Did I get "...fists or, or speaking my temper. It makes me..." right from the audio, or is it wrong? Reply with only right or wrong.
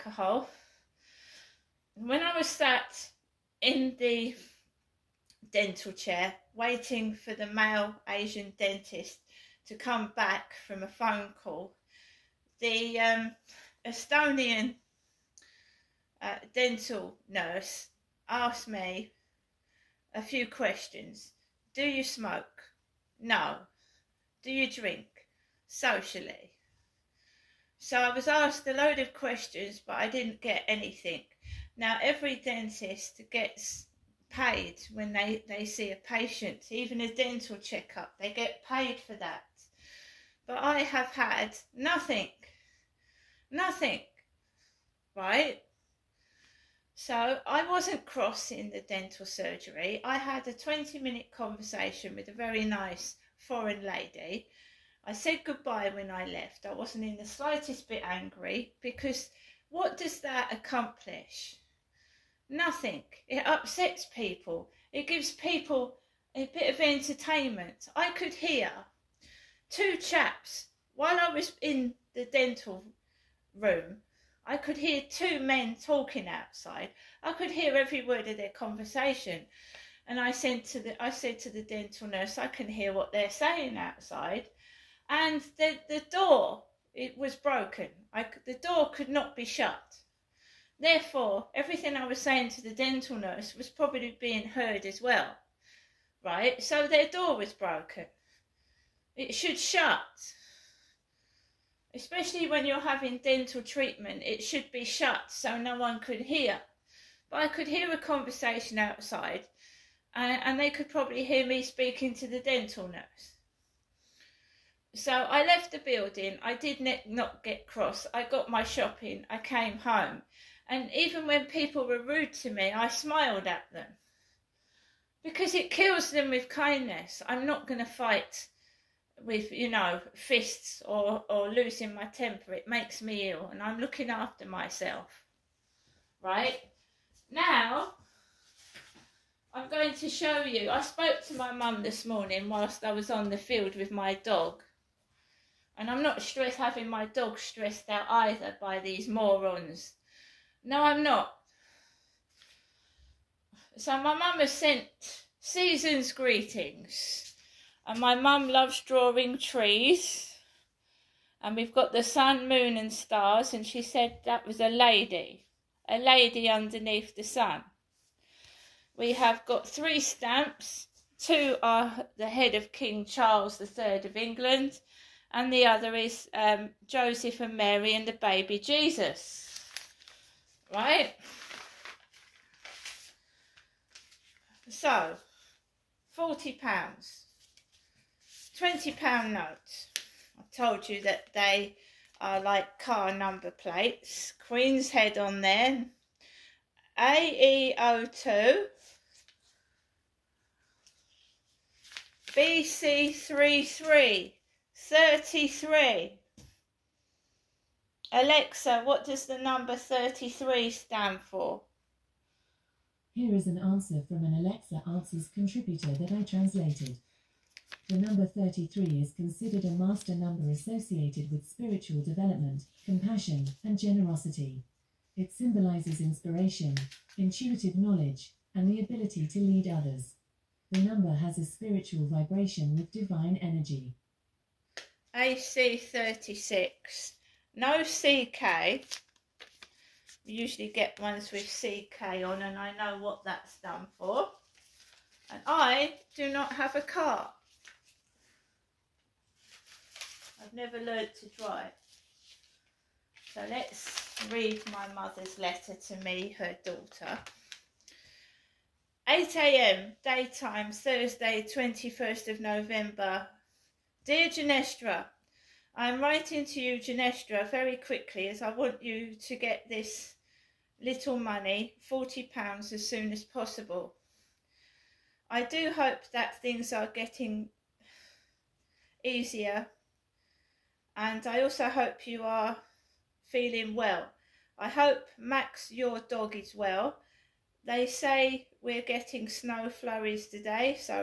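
wrong.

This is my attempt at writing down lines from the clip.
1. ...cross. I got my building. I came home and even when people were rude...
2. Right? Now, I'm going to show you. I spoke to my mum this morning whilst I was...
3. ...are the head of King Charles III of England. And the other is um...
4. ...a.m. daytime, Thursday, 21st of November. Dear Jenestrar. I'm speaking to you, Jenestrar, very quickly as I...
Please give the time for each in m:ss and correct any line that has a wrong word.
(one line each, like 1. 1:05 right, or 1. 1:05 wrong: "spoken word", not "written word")
1. 1:57 wrong: "shopping", not "building"
2. 2:16 right
3. 2:51 right
4. 4:19 wrong: "writing", not "speaking".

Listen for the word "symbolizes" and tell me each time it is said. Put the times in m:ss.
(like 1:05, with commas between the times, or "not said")
3:45.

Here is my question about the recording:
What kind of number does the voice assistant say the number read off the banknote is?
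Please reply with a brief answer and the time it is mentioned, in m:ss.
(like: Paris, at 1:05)
master number, at 3:39.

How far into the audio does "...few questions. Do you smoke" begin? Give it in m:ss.
0:20.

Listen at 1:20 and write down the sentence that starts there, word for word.
And I said to the I said to the dental nurse, I can hear what they're saying outside.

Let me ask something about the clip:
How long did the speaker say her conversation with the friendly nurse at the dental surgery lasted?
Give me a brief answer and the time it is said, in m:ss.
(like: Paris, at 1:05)
20 minutes, at 0:50.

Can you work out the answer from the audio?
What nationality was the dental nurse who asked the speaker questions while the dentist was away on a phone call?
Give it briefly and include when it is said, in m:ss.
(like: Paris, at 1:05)
Estonian, at 0:13.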